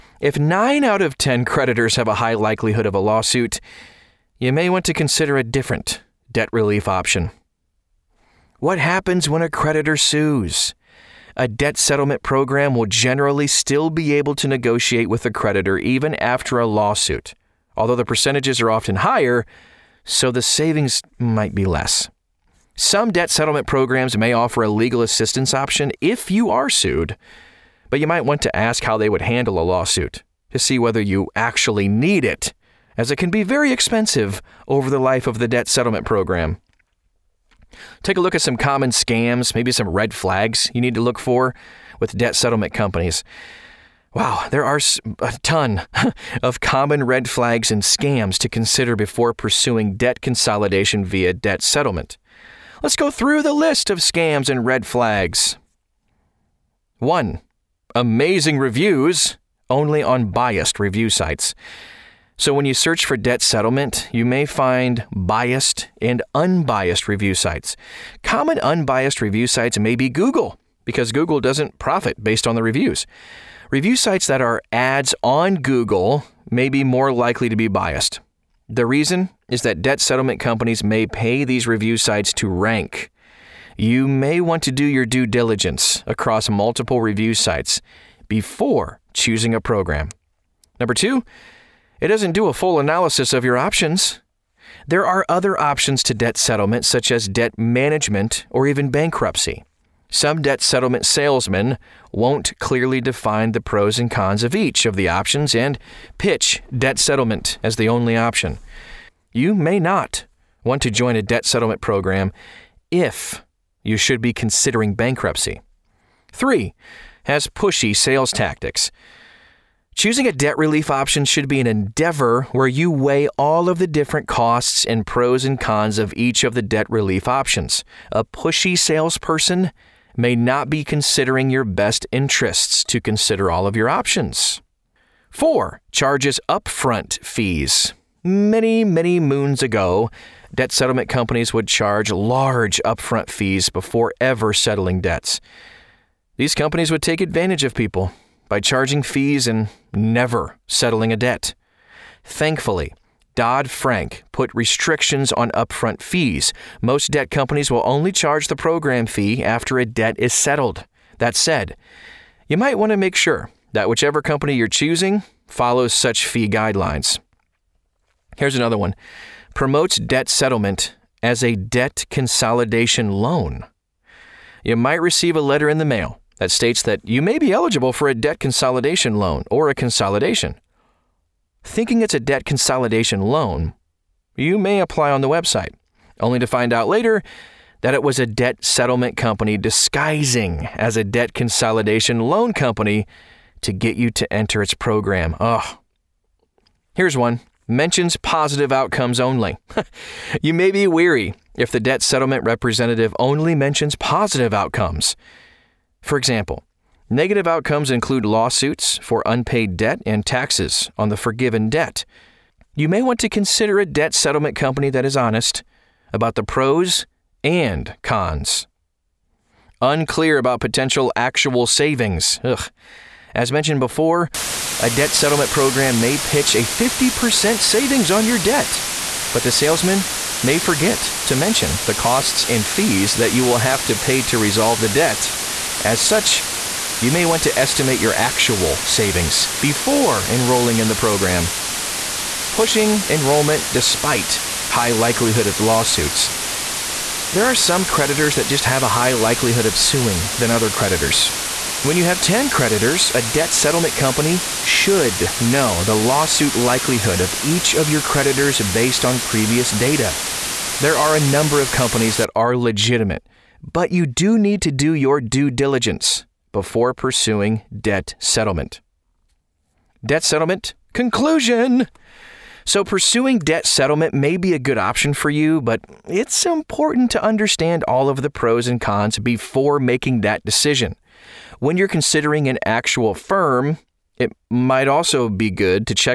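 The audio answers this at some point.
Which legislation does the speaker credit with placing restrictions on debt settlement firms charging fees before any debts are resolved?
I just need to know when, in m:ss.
2:33.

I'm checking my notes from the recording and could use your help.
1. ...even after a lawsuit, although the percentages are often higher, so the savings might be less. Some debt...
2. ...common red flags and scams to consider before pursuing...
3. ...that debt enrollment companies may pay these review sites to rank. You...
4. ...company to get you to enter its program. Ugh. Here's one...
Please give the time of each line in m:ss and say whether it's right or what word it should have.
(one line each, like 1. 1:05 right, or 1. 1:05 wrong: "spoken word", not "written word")
1. 0:15 right
2. 0:46 right
3. 1:19 wrong: "settlement", not "enrollment"
4. 3:12 right.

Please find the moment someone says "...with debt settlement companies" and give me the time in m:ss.
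0:41.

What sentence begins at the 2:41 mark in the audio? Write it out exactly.
That said, you might want to make sure that whichever company you're choosing follows such fee guidelines.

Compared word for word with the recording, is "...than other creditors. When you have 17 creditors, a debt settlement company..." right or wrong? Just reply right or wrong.
wrong.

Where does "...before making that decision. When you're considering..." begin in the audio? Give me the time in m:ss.
4:39.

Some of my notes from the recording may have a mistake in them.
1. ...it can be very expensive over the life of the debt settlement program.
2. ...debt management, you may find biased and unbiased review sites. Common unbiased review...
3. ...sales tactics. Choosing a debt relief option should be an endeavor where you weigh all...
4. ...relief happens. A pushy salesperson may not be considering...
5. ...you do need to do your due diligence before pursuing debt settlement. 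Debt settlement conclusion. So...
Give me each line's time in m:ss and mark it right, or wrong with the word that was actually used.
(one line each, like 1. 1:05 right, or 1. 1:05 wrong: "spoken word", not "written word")
1. 0:33 right
2. 1:03 wrong: "settlement", not "management"
3. 1:57 right
4. 2:06 wrong: "options", not "happens"
5. 4:23 right.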